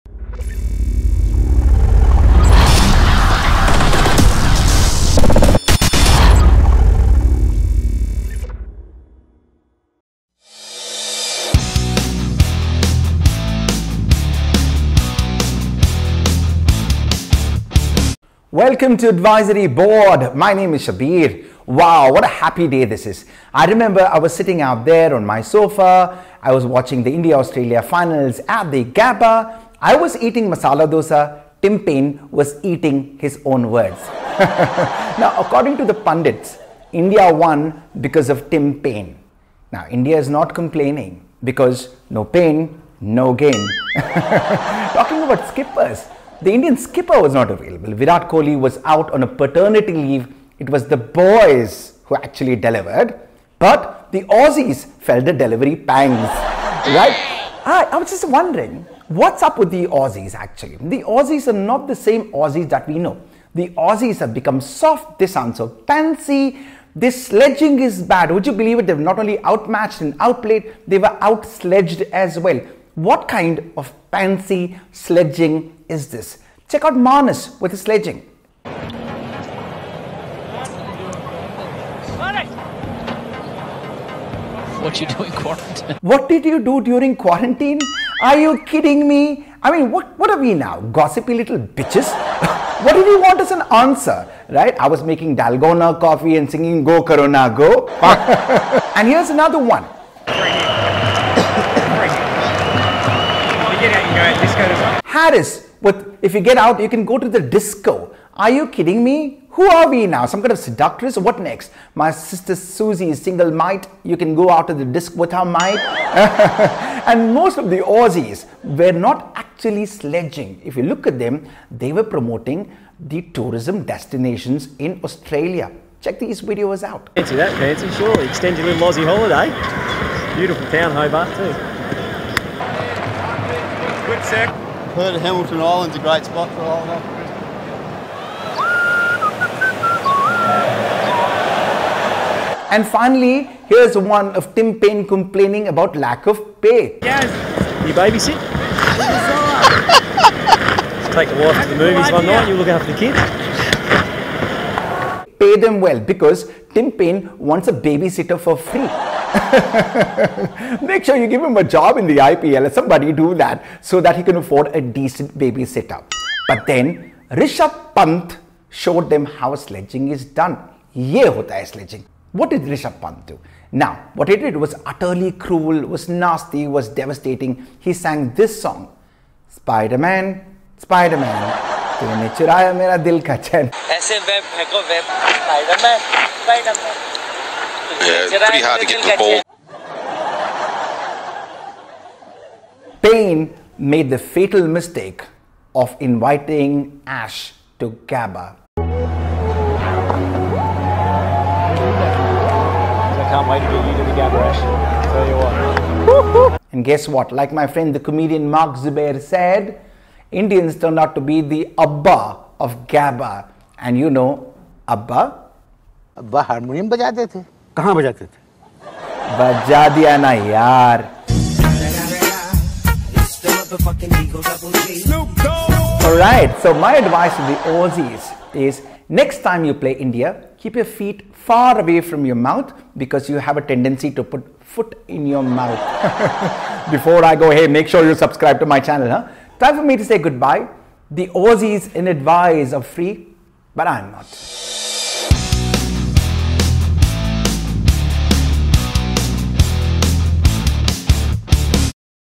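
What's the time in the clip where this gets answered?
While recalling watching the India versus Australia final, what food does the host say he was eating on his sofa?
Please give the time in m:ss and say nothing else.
0:30.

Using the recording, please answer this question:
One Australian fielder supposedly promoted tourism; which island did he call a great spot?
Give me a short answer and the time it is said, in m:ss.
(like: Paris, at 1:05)
Hamilton Island, at 2:15.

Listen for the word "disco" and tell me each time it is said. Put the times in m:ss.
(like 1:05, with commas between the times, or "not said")
1:47, 1:54.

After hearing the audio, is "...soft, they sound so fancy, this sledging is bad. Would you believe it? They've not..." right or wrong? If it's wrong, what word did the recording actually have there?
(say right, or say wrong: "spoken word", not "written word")
right.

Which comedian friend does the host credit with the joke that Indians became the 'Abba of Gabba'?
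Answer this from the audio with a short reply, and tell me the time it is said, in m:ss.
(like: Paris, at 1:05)
Mark Zubair, at 3:28.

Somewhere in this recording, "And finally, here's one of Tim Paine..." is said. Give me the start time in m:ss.
2:22.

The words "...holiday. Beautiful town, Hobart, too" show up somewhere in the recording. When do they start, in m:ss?
2:09.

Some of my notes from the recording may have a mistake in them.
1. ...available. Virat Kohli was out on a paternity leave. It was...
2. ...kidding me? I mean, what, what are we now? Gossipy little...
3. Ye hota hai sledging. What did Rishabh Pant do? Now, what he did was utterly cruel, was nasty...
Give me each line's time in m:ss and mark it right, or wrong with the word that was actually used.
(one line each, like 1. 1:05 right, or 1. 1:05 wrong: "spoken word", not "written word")
1. 0:47 right
2. 1:28 right
3. 2:50 right.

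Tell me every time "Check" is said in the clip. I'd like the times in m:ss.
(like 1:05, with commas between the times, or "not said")
1:16, 2:06.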